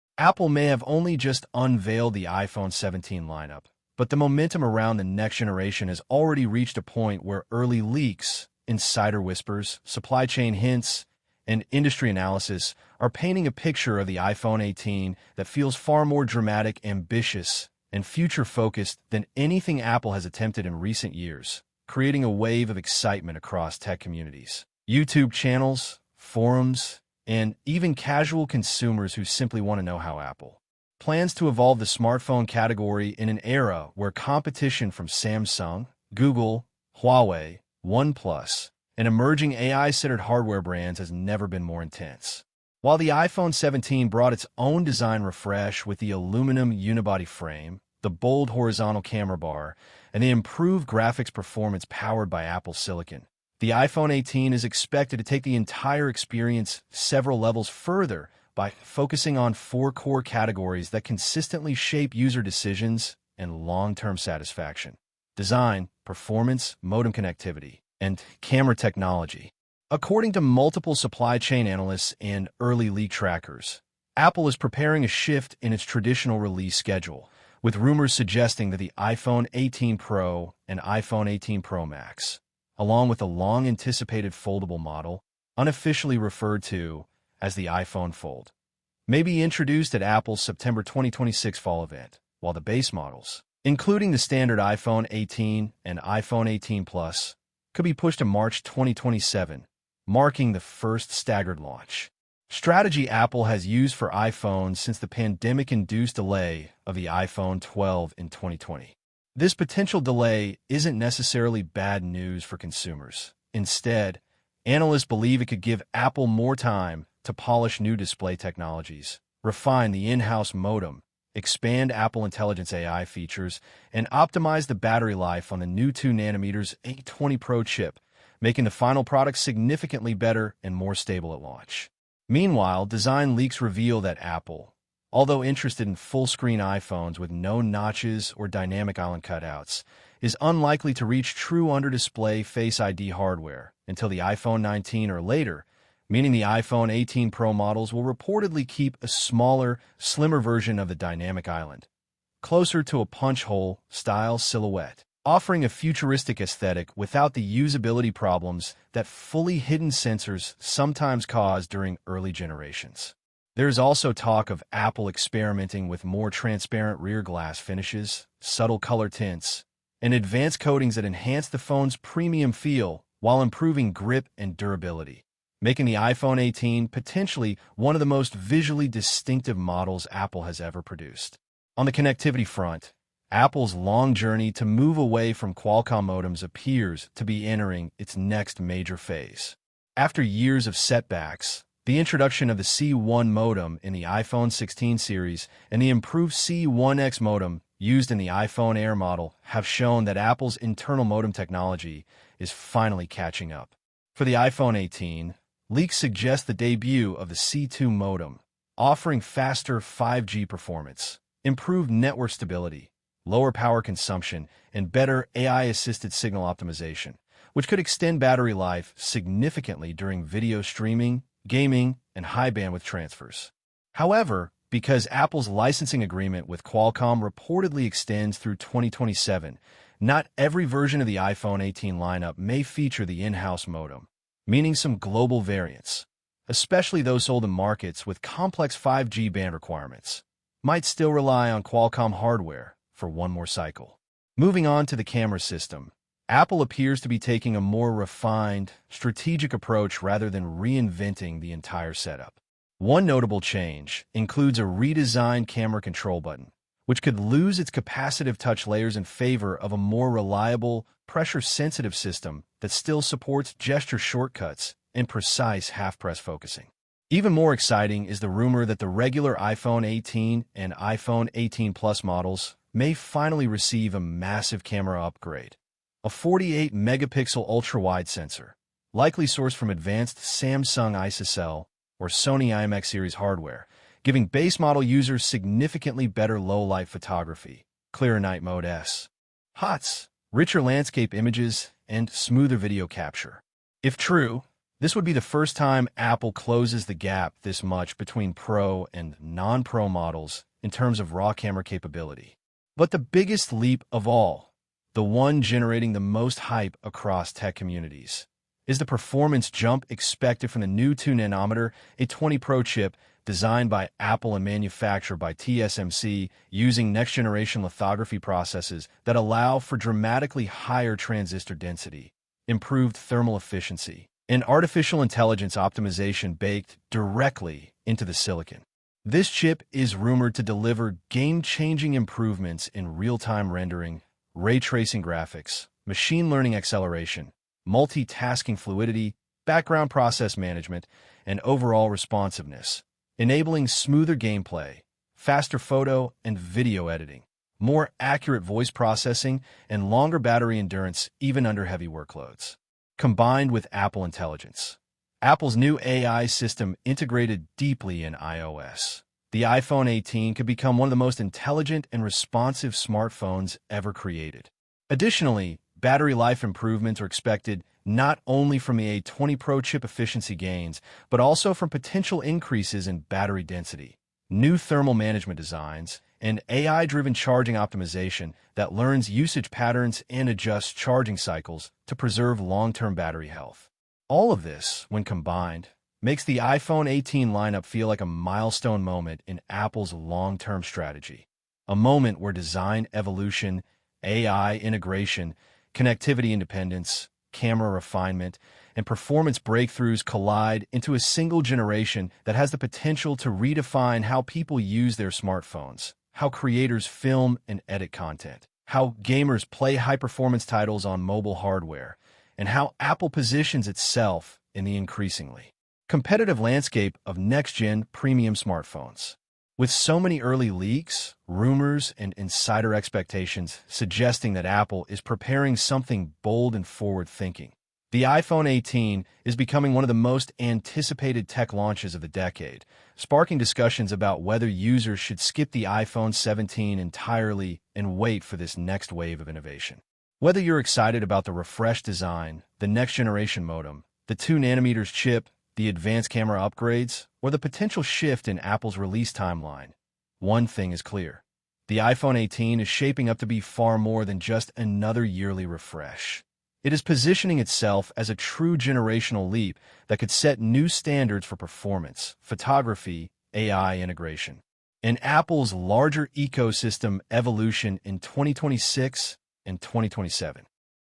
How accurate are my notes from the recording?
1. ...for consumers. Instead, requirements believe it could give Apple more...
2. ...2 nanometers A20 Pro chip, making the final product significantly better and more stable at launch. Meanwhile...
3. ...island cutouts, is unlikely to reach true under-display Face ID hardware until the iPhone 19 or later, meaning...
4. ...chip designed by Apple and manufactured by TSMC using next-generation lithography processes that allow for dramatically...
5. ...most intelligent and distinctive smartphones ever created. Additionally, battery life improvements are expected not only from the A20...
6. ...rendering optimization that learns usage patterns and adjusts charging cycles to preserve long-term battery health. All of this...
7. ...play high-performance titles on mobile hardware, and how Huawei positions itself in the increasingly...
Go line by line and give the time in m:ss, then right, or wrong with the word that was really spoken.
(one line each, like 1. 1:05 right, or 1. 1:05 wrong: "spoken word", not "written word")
1. 1:52 wrong: "analysts", not "requirements"
2. 2:05 right
3. 2:18 right
4. 5:12 right
5. 6:00 wrong: "responsive", not "distinctive"
6. 6:17 wrong: "charging", not "rendering"
7. 6:49 wrong: "Apple", not "Huawei".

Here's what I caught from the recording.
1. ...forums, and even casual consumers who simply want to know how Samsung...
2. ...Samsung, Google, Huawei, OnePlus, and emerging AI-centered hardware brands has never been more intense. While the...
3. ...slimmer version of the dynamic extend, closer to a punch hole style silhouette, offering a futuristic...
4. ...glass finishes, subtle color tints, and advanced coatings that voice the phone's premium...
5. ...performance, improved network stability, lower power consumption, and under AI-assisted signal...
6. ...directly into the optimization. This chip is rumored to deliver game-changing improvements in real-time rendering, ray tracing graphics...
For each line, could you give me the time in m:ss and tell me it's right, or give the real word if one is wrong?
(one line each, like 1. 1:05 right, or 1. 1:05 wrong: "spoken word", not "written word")
1. 0:26 wrong: "Apple", not "Samsung"
2. 0:35 right
3. 2:29 wrong: "island", not "extend"
4. 2:47 wrong: "enhance", not "voice"
5. 3:30 wrong: "better", not "under"
6. 5:26 wrong: "silicon", not "optimization".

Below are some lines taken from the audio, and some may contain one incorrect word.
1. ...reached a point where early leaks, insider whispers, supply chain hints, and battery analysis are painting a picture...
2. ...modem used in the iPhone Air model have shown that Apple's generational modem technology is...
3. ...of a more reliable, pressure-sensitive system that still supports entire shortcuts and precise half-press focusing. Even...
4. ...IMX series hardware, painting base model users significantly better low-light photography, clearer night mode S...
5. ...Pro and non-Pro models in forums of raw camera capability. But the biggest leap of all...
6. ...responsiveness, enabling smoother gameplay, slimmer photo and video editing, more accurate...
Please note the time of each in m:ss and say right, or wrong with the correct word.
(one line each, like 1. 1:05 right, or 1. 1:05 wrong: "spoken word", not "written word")
1. 0:06 wrong: "industry", not "battery"
2. 3:17 wrong: "internal", not "generational"
3. 4:19 wrong: "gesture", not "entire"
4. 4:42 wrong: "giving", not "painting"
5. 4:58 wrong: "terms", not "forums"
6. 5:41 wrong: "faster", not "slimmer".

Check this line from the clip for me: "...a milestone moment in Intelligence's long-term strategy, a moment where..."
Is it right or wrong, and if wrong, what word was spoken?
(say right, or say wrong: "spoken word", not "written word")
wrong: "Apple", not "Intelligence".